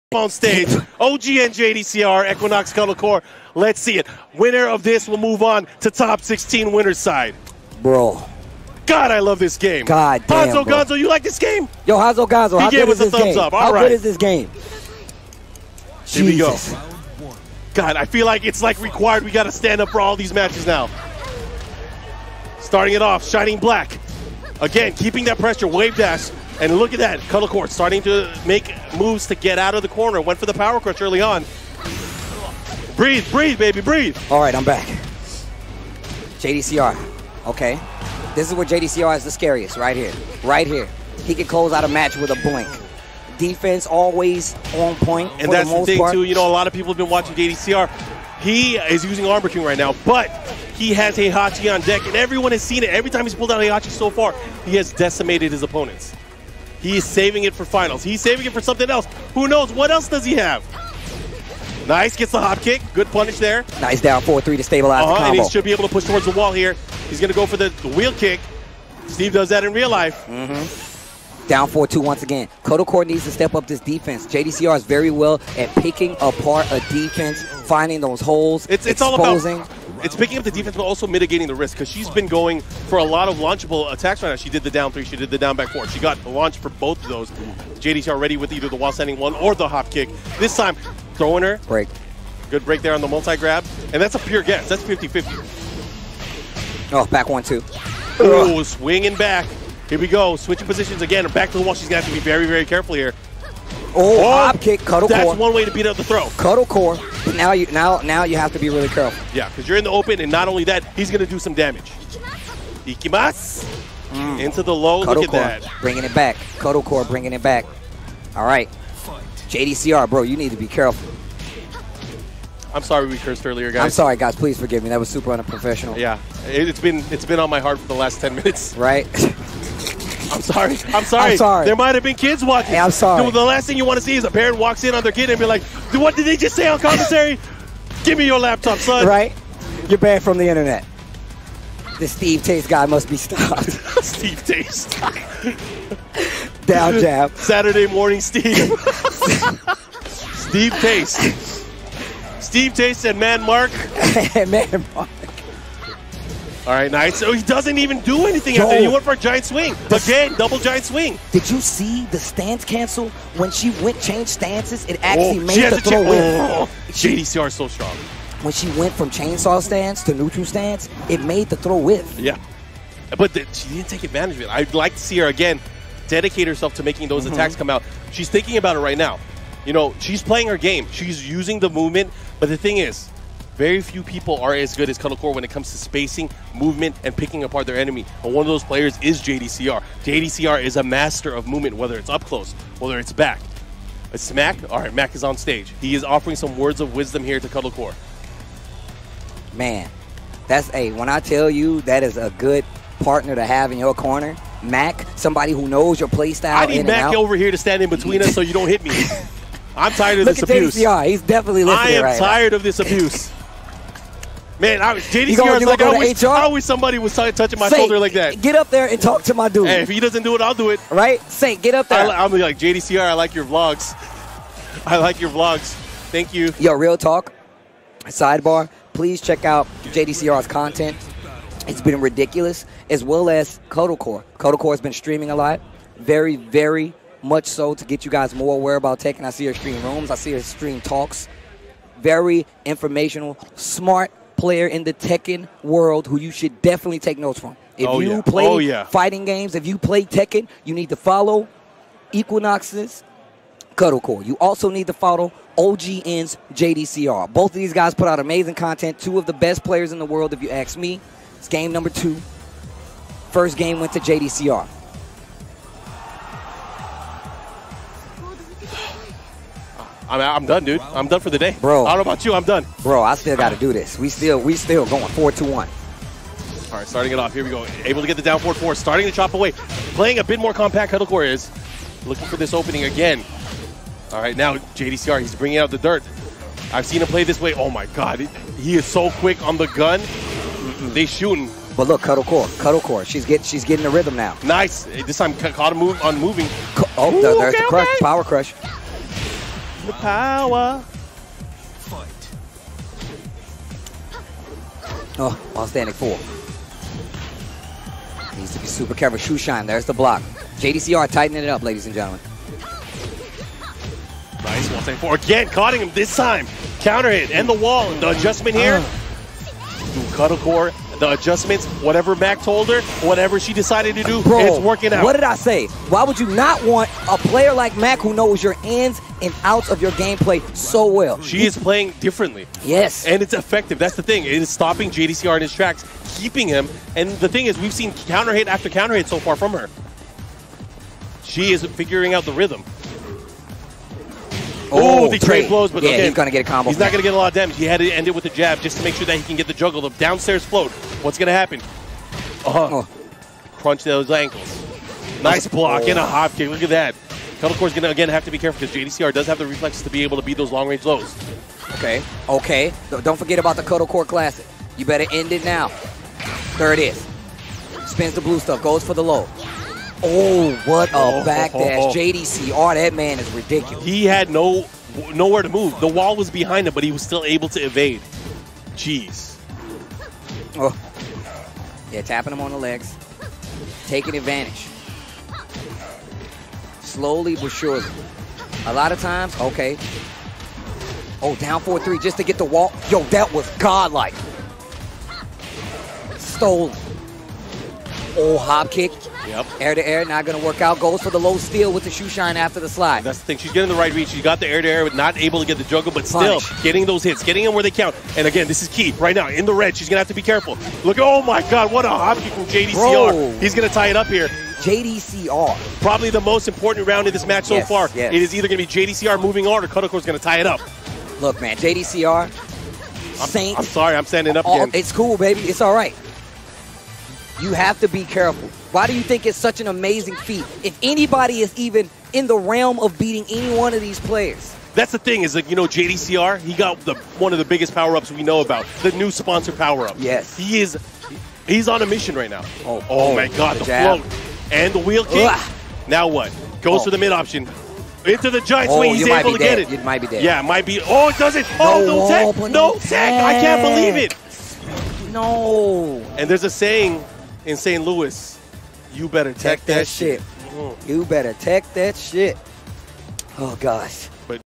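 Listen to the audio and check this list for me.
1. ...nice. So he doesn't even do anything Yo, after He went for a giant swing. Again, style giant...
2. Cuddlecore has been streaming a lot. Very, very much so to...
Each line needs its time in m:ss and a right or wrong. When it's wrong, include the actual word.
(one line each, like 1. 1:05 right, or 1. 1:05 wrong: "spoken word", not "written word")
1. 2:36 wrong: "double", not "style"
2. 3:54 right.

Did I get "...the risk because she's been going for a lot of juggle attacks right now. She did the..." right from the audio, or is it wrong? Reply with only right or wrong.
wrong.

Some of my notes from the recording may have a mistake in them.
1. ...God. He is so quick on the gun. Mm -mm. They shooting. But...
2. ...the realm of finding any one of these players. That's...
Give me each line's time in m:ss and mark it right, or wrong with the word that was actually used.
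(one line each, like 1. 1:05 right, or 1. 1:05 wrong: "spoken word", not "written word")
1. 4:47 right
2. 7:12 wrong: "beating", not "finding".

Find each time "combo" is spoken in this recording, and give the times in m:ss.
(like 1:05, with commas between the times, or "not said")
1:05, 5:46.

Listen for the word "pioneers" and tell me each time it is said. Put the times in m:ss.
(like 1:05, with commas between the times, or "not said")
not said.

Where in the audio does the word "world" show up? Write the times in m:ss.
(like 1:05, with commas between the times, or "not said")
4:05, 4:20.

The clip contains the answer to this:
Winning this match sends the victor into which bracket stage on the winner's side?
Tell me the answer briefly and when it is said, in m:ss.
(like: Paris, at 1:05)
top 16, at 0:05.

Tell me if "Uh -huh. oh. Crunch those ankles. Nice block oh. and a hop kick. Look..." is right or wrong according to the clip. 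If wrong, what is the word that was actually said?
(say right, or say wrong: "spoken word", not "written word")
right.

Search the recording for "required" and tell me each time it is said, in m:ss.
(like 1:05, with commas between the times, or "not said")
0:18.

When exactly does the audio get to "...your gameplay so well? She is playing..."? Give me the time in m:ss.
5:29.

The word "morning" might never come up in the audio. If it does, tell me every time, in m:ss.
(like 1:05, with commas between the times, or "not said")
2:27.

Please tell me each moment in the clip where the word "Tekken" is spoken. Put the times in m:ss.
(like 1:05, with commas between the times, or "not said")
4:04, 4:10.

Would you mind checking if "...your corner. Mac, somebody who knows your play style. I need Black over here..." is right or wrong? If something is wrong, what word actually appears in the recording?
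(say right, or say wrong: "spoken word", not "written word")
wrong: "Mac", not "Black".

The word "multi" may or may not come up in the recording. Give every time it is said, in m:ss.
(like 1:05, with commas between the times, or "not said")
1:33.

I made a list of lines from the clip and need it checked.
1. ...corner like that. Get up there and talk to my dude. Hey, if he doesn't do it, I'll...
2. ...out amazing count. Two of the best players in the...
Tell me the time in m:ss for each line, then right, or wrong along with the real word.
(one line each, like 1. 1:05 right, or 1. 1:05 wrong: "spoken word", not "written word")
1. 3:37 wrong: "shoulder", not "corner"
2. 4:18 wrong: "content", not "count".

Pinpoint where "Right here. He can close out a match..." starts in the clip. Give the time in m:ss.
0:40.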